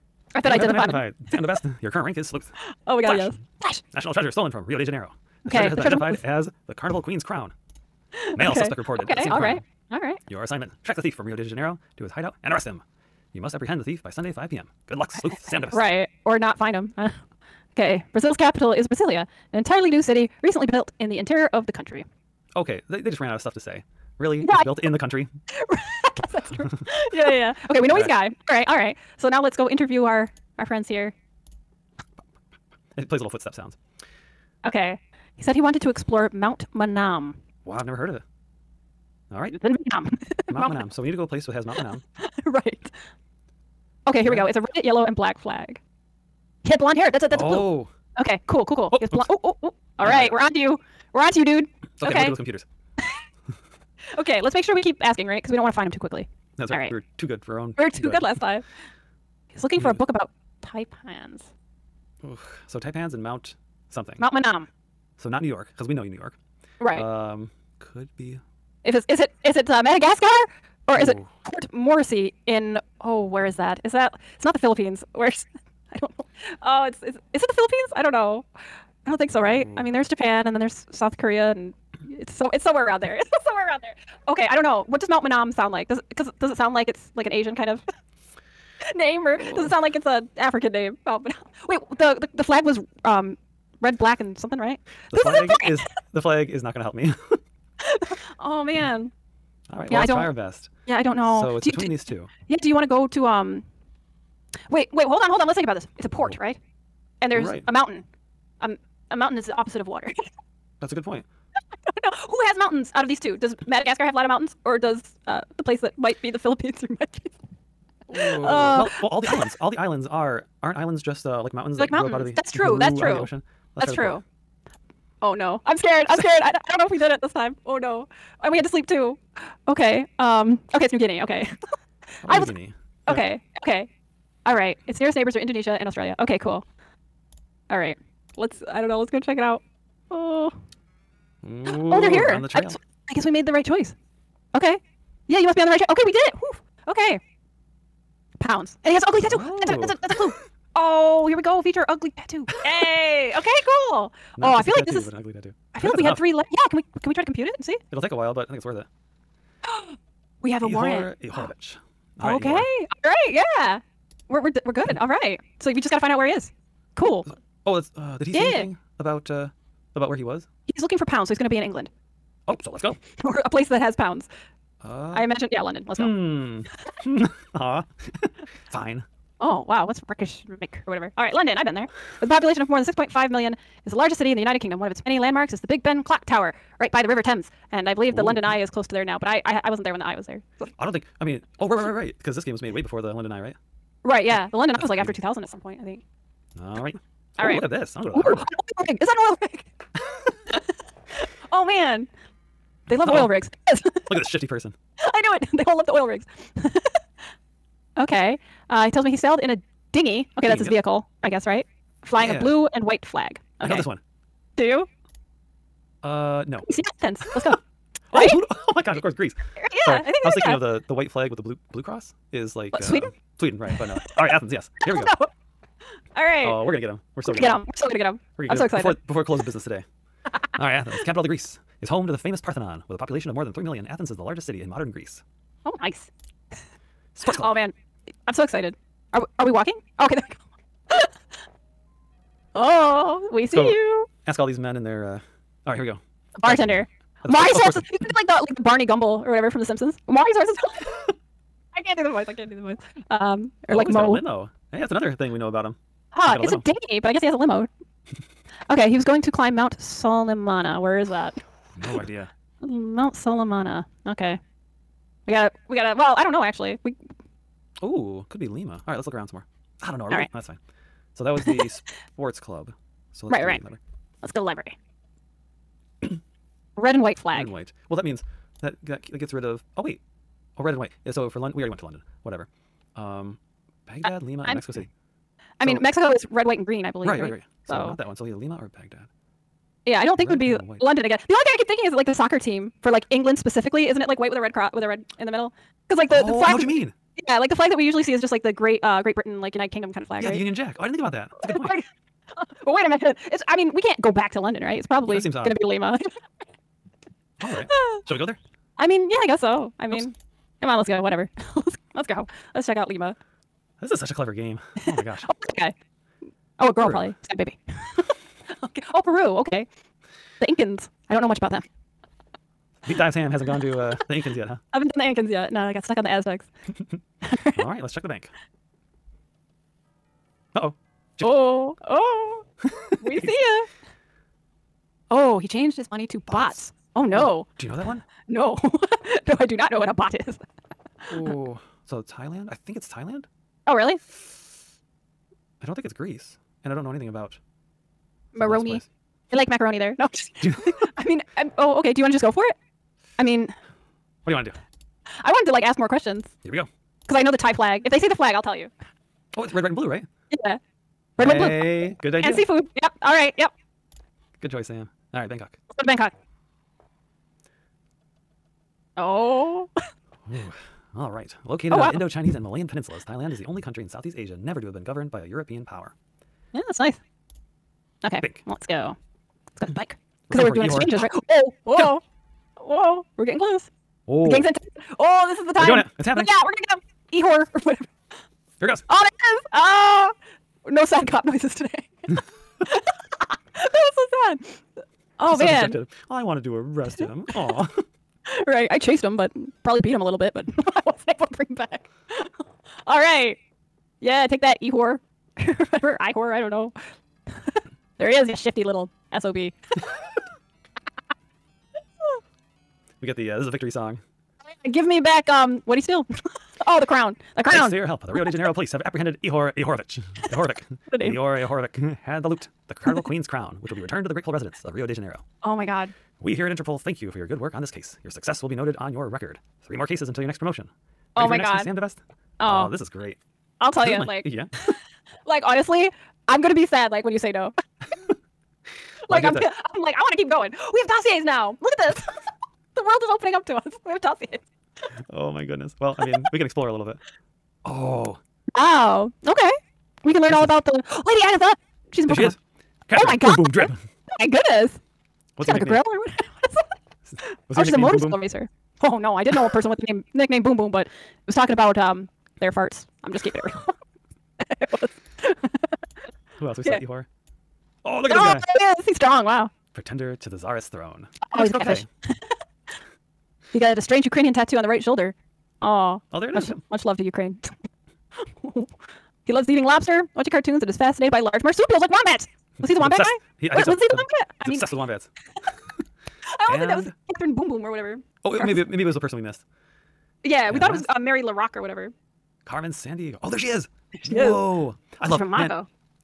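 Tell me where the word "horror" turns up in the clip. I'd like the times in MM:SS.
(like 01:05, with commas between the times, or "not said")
06:46.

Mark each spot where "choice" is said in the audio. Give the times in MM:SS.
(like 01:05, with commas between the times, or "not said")
02:23, 06:04.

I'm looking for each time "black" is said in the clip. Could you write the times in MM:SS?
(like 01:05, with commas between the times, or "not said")
00:45, 01:33.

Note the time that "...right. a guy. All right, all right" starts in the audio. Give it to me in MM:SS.
00:28.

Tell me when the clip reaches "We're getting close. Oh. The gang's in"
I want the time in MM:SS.
06:23.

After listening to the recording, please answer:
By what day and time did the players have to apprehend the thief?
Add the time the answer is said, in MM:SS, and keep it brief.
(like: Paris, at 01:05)
Sunday, 5 p.m., at 00:14.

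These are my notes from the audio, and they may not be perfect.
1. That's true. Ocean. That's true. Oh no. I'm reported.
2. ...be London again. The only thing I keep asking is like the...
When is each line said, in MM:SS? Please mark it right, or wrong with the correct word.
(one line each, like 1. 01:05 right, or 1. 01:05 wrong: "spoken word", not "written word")
1. 02:02 wrong: "scared", not "reported"
2. 04:50 wrong: "thinking", not "asking".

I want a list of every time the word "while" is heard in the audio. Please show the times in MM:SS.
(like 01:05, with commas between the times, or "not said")
02:38.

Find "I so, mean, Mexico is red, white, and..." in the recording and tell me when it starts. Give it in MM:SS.
04:45.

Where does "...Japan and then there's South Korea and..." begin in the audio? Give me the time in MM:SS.
01:20.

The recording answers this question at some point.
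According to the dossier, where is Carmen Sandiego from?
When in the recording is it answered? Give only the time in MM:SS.
08:15.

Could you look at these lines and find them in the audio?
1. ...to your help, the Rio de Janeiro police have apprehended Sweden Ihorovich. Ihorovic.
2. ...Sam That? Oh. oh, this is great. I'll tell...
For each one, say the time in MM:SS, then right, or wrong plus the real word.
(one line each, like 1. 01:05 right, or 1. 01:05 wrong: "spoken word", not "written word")
1. 06:57 wrong: "Ihor", not "Sweden"
2. 07:11 wrong: "DeVest", not "That".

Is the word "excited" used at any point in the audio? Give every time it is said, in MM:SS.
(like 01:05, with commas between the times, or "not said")
03:48, 03:58.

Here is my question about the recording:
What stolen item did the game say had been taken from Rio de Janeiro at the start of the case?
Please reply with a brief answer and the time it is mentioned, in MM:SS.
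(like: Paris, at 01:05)
Carnival Queen's crown, at 00:06.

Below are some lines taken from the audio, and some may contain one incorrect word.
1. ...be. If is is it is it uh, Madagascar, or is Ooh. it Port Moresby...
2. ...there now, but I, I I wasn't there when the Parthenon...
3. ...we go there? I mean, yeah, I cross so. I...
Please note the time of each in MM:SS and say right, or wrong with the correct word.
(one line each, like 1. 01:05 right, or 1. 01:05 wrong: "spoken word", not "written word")
1. 01:08 right
2. 03:08 wrong: "Eye", not "Parthenon"
3. 05:08 wrong: "guess", not "cross".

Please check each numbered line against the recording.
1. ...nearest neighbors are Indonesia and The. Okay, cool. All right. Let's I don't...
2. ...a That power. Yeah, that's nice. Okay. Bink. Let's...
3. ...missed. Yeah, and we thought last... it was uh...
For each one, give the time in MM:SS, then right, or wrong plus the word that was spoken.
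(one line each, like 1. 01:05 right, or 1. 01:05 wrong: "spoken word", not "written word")
1. 02:14 wrong: "Australia", not "The"
2. 06:15 wrong: "European", not "That"
3. 08:09 right.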